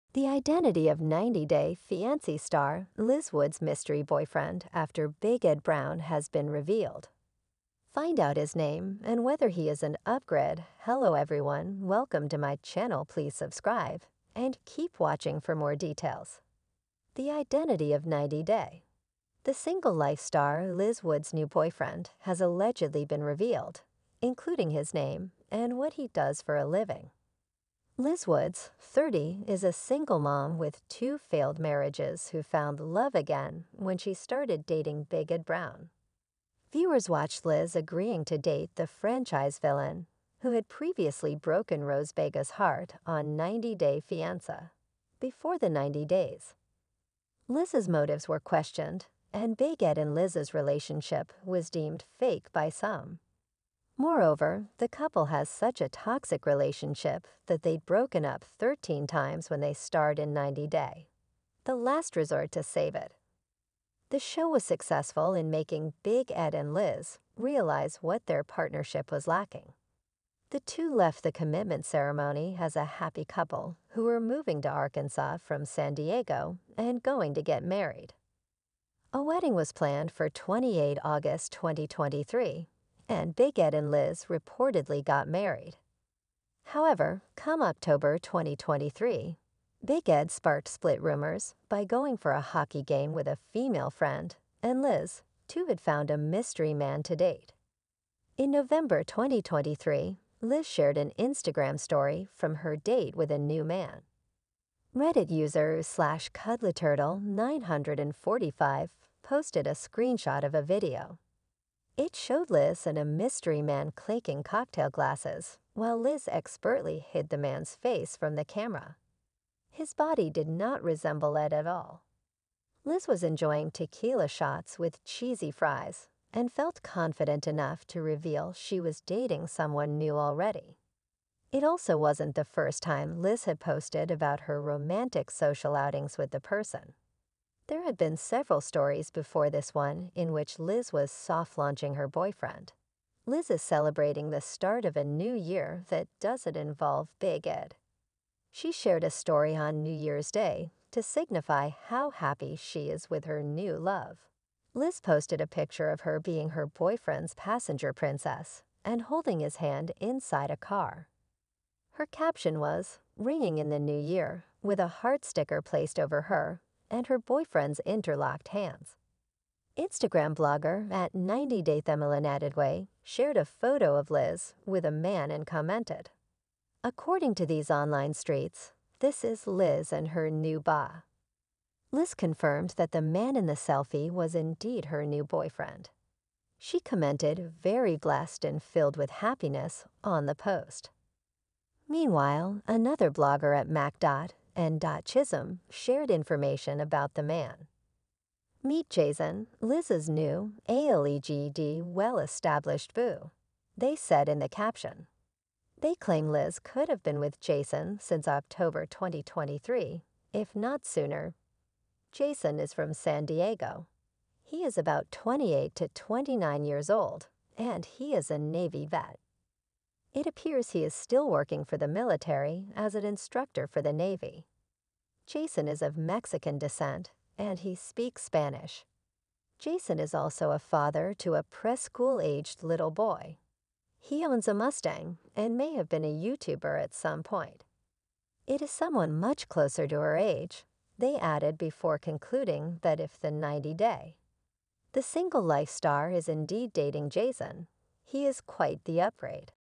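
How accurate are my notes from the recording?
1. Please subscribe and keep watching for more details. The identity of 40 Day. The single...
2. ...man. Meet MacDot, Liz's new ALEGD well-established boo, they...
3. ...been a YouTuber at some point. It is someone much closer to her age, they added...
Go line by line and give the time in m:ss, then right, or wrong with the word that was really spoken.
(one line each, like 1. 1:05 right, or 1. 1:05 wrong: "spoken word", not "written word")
1. 0:13 wrong: "90", not "40"
2. 3:17 wrong: "Jason", not "MacDot"
3. 3:55 right.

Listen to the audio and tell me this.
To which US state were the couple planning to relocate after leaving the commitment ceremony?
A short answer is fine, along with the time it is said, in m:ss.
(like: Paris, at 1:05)
Arkansas, at 1:14.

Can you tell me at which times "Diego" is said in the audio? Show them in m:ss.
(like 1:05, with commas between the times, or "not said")
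1:15, 3:33.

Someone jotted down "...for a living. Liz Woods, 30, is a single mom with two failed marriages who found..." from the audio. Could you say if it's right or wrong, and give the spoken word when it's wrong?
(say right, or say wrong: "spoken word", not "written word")
right.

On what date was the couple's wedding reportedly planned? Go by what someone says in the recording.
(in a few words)
28 August 2023.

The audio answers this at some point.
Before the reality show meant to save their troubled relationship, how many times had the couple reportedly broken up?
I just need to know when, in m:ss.
0:58.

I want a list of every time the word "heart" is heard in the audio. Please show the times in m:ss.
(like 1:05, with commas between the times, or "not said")
0:42, 2:44.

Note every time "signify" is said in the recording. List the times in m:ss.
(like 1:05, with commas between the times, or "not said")
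2:31.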